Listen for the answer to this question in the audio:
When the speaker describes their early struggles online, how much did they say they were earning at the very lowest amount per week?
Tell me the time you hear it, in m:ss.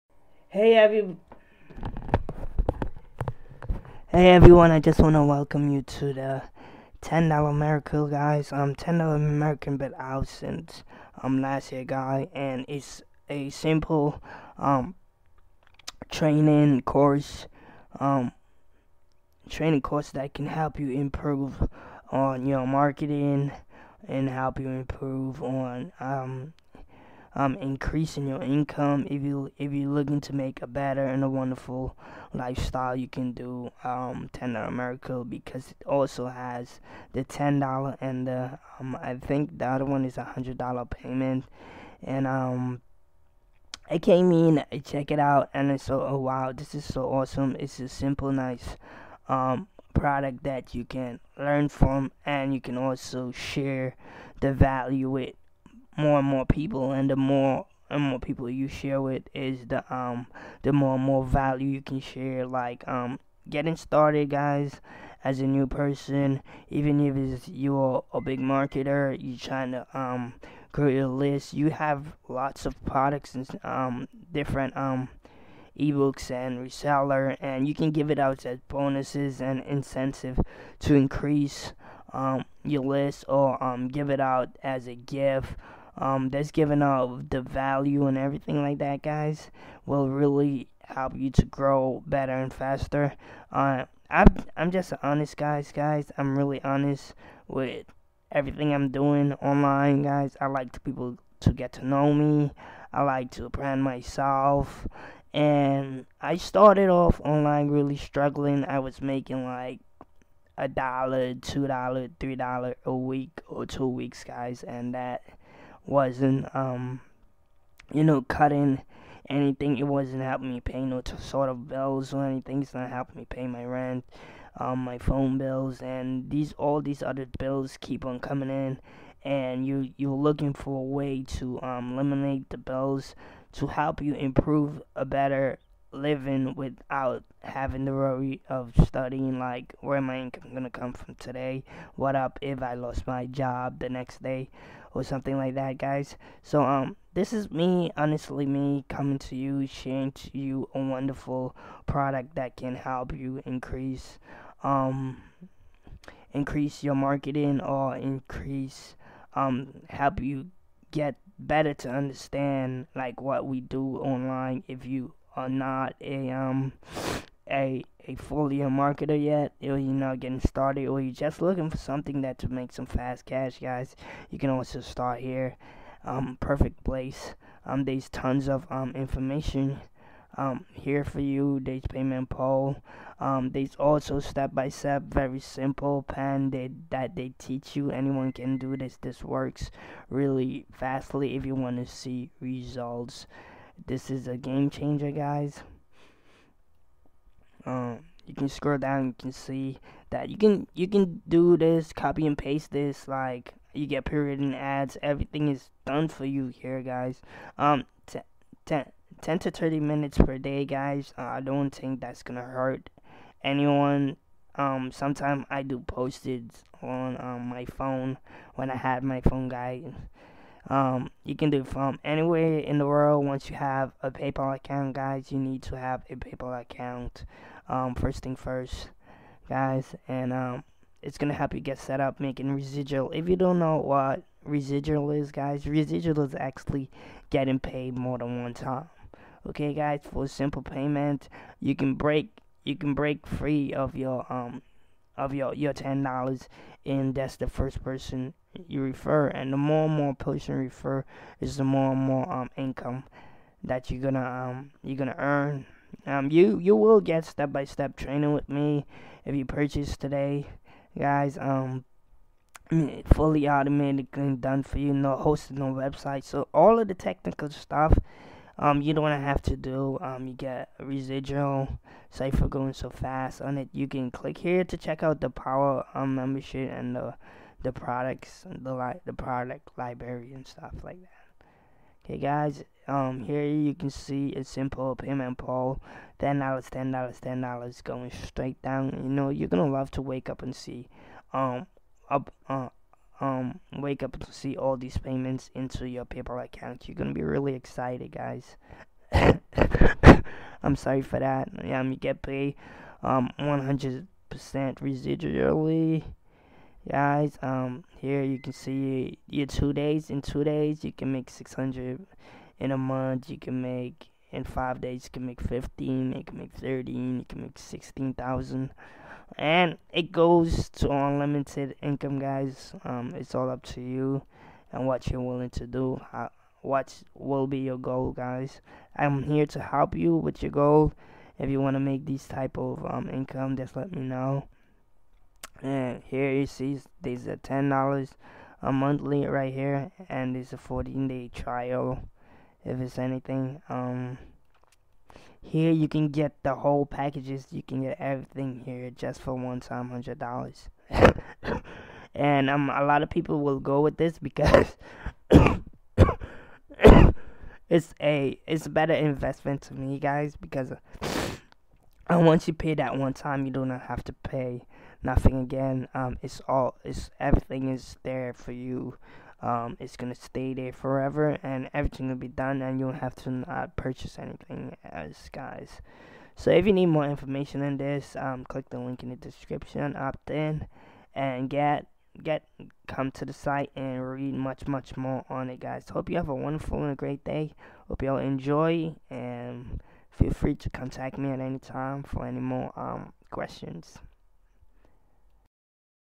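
1:50.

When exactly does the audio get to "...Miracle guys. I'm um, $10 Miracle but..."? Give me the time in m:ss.
0:07.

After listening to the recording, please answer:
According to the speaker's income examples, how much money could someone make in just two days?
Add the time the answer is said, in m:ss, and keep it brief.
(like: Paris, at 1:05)
600, at 5:11.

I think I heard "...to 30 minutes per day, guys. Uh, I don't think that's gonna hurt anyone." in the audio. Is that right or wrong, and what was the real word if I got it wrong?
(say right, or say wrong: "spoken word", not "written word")
right.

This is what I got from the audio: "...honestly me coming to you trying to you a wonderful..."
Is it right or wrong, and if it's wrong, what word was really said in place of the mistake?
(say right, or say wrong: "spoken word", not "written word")
wrong: "sharing", not "trying".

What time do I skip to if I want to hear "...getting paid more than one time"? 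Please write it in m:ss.
3:57.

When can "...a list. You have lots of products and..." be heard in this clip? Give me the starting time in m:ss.
1:10.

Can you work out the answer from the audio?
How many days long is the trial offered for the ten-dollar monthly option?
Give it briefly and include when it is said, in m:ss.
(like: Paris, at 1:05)
14 days, at 5:40.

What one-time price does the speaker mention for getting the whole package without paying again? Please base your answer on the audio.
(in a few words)
$100.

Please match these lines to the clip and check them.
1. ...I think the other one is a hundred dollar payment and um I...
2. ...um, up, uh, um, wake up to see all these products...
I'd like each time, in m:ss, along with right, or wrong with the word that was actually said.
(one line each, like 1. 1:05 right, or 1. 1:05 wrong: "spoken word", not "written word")
1. 0:39 right
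2. 4:51 wrong: "payments", not "products".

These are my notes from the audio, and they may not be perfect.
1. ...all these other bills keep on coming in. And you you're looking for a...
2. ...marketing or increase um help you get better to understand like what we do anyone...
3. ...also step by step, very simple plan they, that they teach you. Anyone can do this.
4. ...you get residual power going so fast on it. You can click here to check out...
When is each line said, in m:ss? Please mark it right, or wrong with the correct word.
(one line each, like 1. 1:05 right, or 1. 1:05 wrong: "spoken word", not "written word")
1. 2:06 right
2. 2:36 wrong: "online", not "anyone"
3. 3:03 right
4. 4:30 wrong: "cipher", not "power".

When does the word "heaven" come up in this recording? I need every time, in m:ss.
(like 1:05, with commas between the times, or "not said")
not said.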